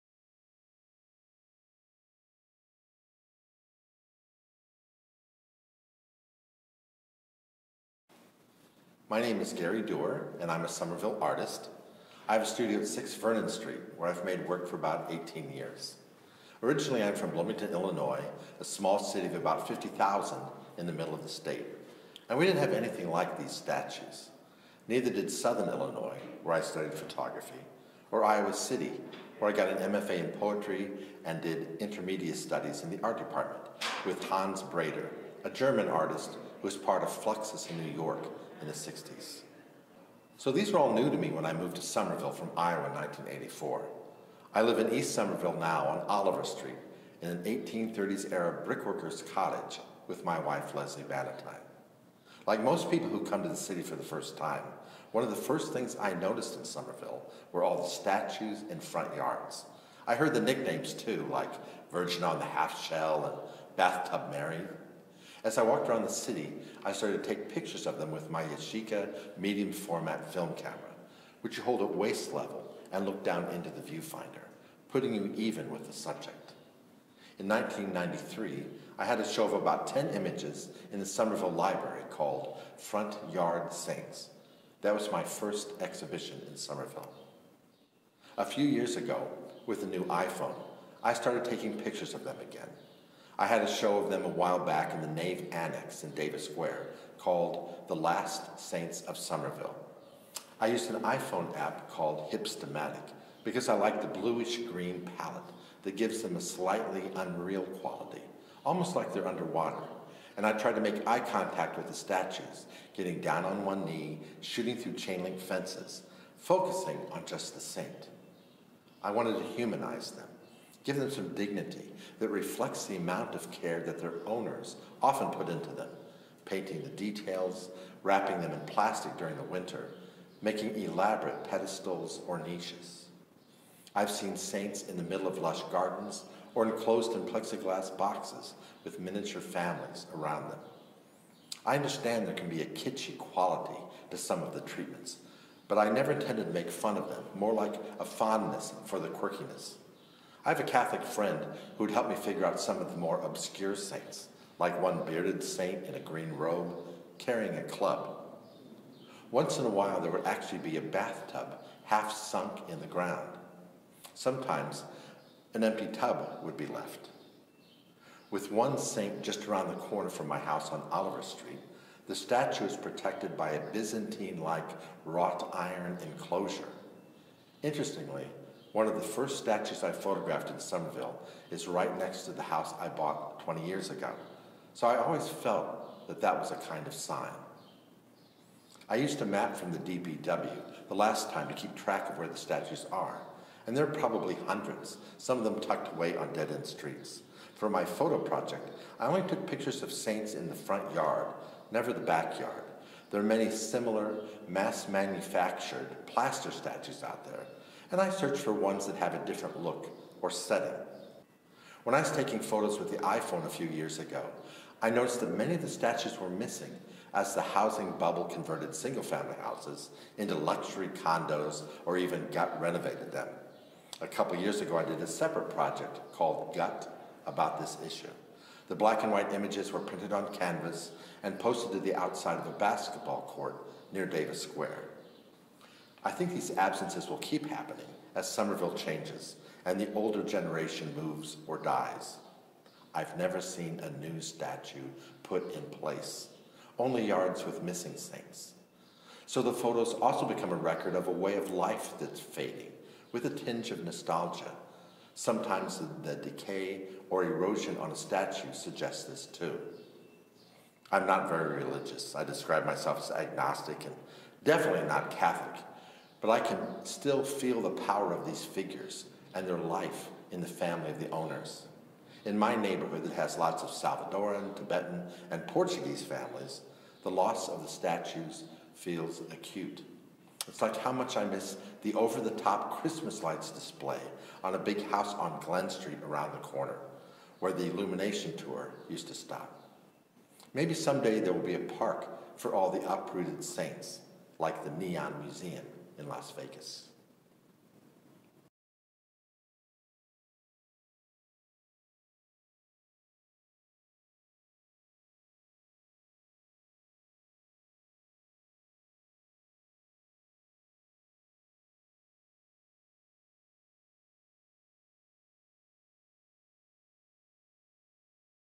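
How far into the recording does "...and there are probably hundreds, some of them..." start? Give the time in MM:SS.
03:13.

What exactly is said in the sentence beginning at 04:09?
So the photos also become a record of a way of life that's fading, with a tinge of nostalgia.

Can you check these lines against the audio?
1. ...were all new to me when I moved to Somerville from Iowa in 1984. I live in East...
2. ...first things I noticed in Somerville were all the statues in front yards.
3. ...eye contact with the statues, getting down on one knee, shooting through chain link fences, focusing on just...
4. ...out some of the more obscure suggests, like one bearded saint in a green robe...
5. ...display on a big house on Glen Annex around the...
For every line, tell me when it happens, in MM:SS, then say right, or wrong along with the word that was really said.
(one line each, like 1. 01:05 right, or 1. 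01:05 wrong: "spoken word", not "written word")
1. 00:40 right
2. 00:55 right
3. 01:51 right
4. 02:32 wrong: "saints", not "suggests"
5. 04:43 wrong: "Street", not "Annex".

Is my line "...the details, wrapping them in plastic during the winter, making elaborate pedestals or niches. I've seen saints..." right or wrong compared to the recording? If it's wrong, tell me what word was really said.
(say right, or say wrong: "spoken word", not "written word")
right.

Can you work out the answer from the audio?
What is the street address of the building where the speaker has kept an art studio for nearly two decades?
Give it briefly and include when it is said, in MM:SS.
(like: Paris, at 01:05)
6 Vernon Street, at 00:12.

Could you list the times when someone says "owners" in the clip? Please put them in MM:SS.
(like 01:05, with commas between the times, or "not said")
02:04, 04:31.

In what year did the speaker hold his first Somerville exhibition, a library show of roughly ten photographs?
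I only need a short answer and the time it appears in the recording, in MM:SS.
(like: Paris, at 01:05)
1993, at 01:17.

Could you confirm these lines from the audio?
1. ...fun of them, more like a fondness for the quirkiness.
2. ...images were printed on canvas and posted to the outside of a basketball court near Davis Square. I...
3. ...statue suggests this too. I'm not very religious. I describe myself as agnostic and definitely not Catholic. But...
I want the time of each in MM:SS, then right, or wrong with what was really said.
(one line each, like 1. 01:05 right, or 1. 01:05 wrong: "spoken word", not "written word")
1. 02:26 right
2. 03:49 right
3. 04:17 right.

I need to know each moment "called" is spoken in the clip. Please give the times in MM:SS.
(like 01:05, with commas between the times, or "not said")
01:22, 01:37, 01:41, 03:46.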